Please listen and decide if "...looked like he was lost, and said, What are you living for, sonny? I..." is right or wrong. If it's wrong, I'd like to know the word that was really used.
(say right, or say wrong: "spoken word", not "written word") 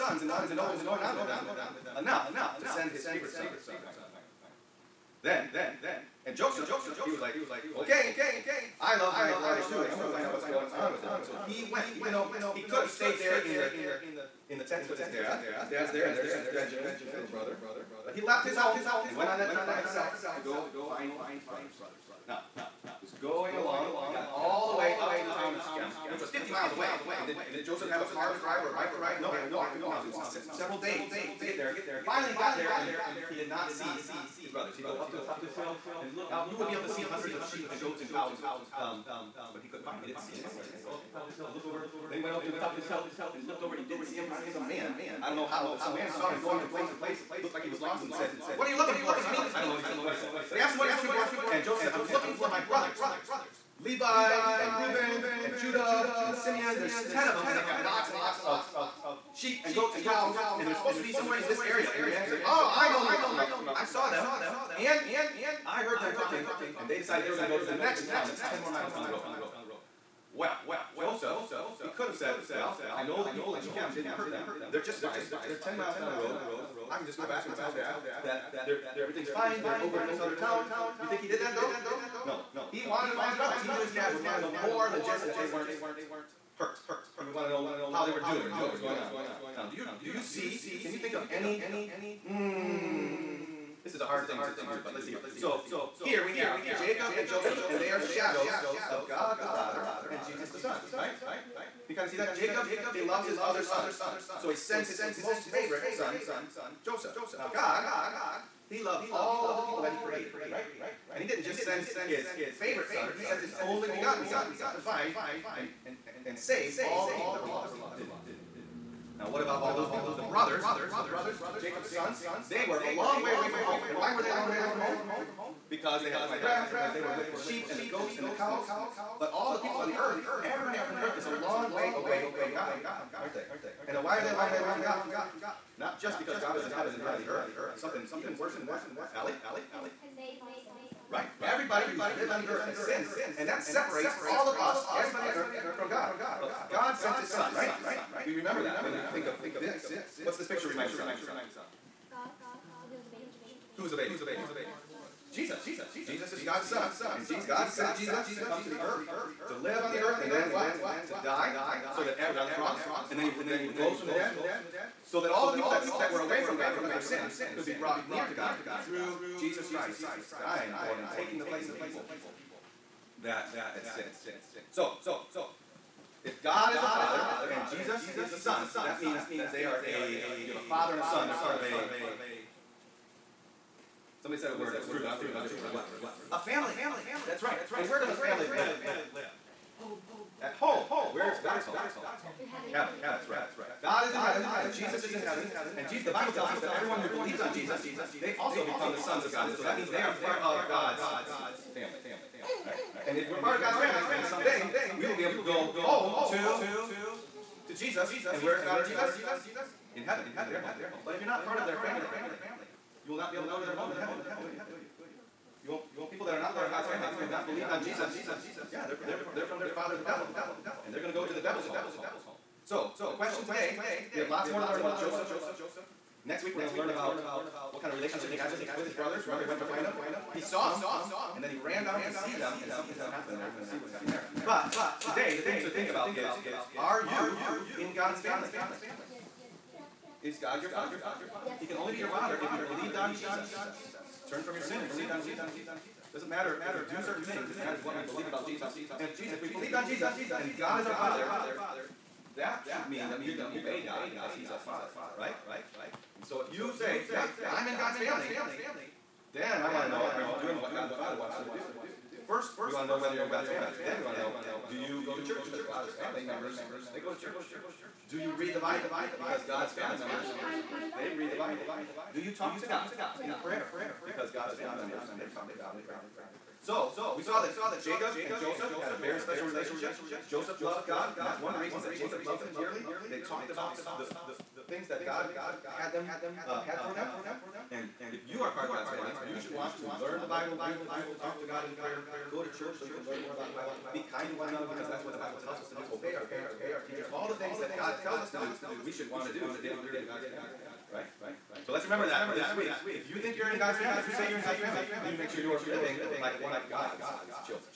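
wrong: "looking", not "living".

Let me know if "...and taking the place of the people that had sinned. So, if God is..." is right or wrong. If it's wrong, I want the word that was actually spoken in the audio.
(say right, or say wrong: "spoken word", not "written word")
right.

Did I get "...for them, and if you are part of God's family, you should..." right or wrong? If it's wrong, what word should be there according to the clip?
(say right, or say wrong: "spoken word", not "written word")
right.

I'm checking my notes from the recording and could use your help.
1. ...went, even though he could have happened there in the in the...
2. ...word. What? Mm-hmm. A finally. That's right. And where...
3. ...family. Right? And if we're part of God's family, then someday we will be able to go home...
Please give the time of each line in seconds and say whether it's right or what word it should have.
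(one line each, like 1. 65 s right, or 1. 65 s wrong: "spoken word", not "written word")
1. 11 s wrong: "stayed", not "happened"
2. 185 s wrong: "family", not "finally"
3. 201 s right.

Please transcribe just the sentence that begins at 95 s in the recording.
So here we have Jacob and Joseph, and they are shadows of God the Father and Jesus the Son, right?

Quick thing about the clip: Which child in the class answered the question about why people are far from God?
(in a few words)
Allie.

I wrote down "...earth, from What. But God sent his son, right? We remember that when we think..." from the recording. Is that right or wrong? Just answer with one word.
wrong.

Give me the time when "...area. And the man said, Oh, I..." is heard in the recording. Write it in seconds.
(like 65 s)
61 s.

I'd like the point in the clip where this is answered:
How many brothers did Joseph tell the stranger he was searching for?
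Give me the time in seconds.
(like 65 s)
57 s.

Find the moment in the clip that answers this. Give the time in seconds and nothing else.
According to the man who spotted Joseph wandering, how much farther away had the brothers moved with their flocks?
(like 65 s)
68 s.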